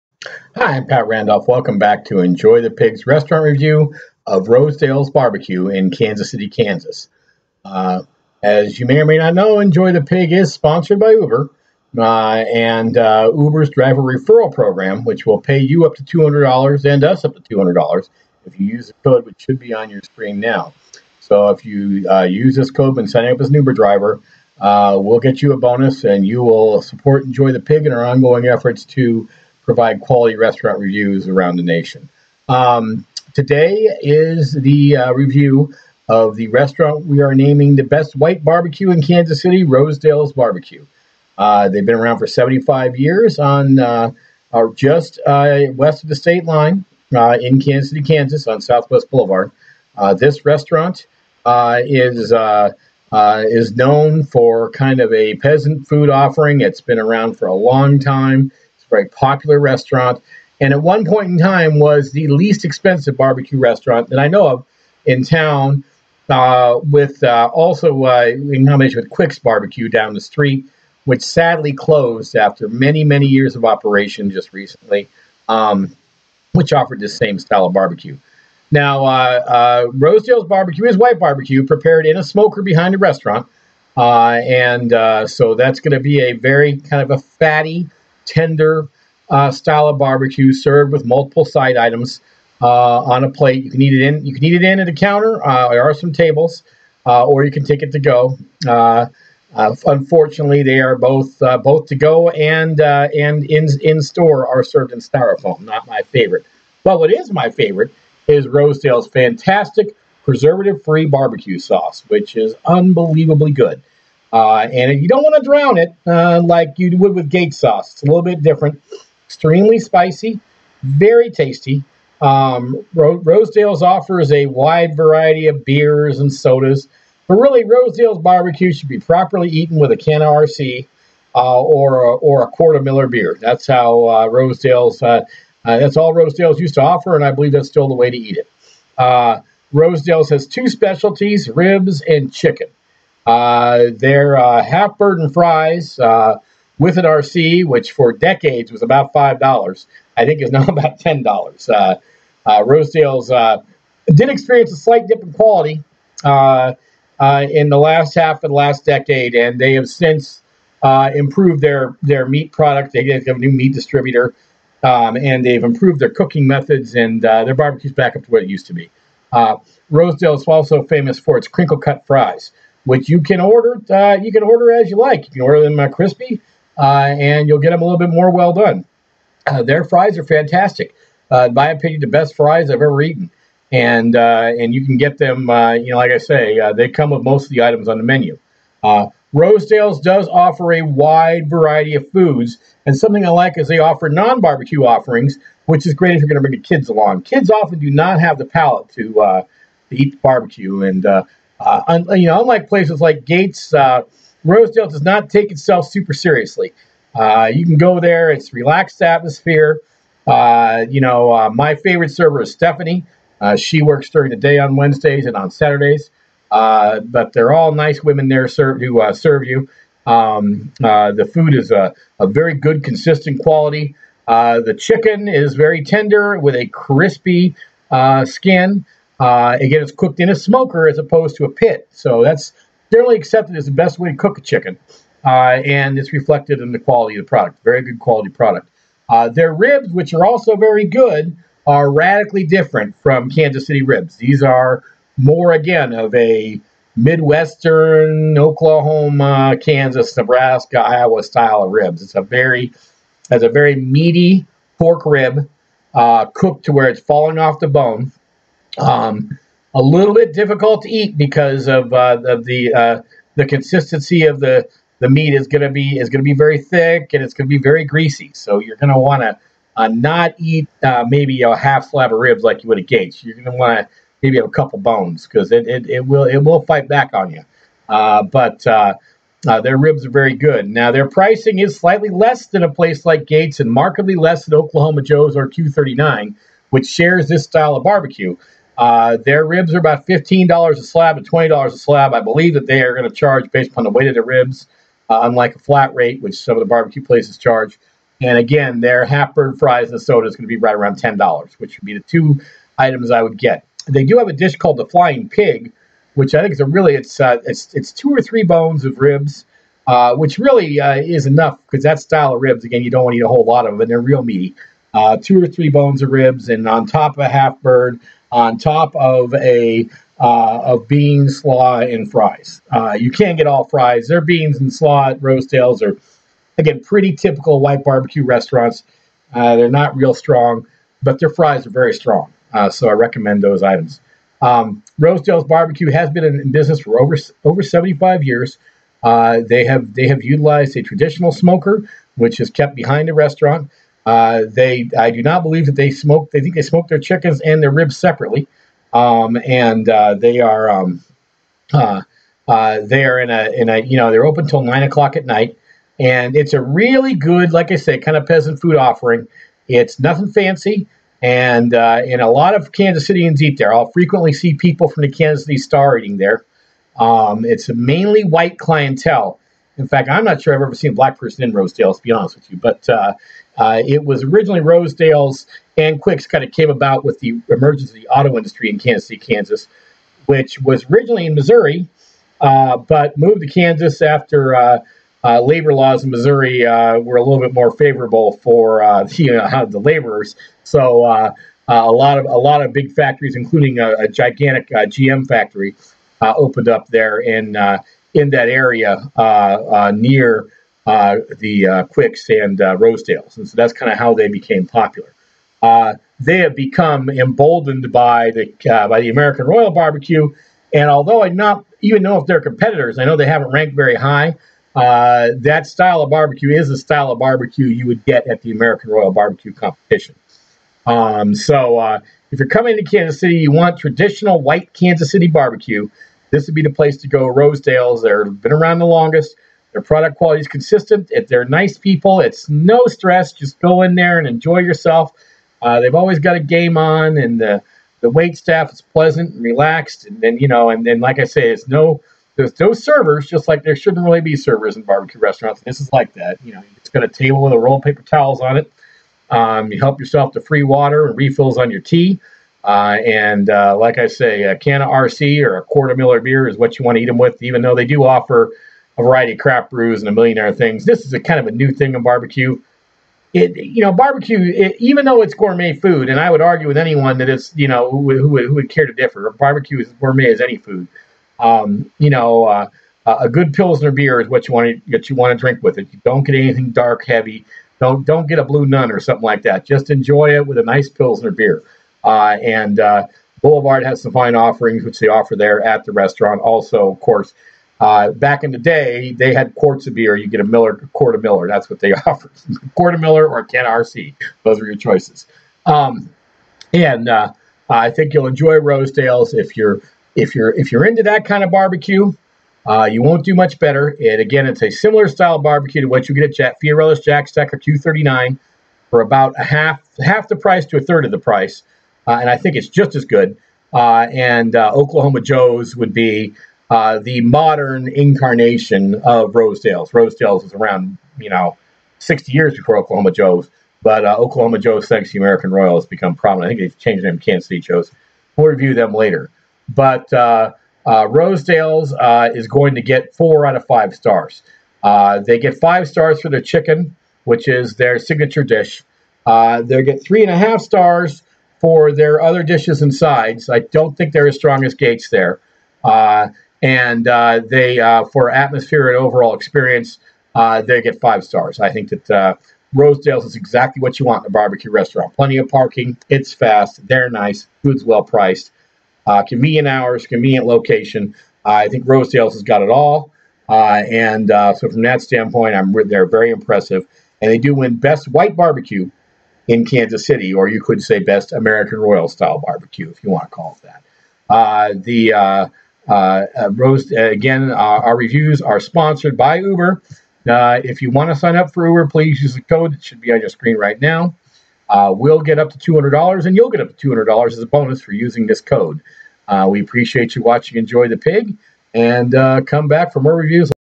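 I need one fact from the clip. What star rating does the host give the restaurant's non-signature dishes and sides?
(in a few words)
3.5 stars.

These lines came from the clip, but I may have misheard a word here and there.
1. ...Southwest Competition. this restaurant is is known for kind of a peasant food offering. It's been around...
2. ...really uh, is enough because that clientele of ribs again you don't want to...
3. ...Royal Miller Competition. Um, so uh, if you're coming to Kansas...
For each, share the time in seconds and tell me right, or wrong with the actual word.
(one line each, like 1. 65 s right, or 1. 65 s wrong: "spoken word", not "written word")
1. 48 s wrong: "Boulevard", not "Competition"
2. 310 s wrong: "style", not "clientele"
3. 418 s wrong: "Barbecue", not "Miller".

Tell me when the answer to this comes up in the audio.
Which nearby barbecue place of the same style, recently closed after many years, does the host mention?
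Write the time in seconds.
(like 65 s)
69 s.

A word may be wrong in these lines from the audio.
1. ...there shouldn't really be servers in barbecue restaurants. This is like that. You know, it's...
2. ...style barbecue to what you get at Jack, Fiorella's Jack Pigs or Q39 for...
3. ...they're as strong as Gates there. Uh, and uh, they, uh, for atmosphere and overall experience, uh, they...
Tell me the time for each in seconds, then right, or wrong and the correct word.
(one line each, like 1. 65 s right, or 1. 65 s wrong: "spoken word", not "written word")
1. 443 s right
2. 505 s wrong: "Stack", not "Pigs"
3. 544 s right.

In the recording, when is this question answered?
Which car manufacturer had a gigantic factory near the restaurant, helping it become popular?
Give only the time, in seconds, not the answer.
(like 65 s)
394 s.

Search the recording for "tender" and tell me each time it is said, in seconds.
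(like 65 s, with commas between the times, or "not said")
88 s, 225 s.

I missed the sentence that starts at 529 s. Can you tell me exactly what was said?
But uh, Rosedale's uh, is going to get four out of five stars.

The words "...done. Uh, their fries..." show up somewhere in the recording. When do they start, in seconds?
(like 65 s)
178 s.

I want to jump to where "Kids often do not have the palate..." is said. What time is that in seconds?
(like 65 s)
197 s.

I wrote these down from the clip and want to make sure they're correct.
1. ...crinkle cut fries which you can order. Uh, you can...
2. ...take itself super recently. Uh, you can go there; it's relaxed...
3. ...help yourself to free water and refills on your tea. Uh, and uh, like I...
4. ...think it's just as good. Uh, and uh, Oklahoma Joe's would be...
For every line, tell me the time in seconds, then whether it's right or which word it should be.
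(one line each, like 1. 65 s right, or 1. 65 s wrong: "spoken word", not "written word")
1. 171 s right
2. 205 s wrong: "seriously", not "recently"
3. 449 s right
4. 512 s right.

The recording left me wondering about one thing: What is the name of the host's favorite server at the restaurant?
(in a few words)
Stephanie.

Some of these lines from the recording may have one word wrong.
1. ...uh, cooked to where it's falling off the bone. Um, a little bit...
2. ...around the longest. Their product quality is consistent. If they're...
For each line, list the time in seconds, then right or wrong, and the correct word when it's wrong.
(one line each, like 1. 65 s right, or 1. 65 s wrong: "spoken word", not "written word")
1. 255 s right
2. 428 s right.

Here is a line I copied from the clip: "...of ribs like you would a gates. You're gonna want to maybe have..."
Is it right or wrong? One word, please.
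right.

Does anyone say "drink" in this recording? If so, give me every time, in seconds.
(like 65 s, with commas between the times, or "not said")
475 s.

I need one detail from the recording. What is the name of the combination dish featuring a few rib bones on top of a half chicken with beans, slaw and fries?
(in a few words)
Flying Pig.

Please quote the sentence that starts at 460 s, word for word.
This is a kind of a new thing in barbecue.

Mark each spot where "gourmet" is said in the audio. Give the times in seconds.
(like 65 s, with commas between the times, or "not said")
465 s, 469 s.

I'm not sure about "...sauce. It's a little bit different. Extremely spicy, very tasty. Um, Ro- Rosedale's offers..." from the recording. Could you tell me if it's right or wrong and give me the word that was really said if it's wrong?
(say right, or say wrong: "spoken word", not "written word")
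right.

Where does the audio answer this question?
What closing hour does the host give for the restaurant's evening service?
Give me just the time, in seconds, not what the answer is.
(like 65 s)
354 s.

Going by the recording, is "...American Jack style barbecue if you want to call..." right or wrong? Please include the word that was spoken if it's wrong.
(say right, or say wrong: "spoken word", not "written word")
wrong: "Royal", not "Jack".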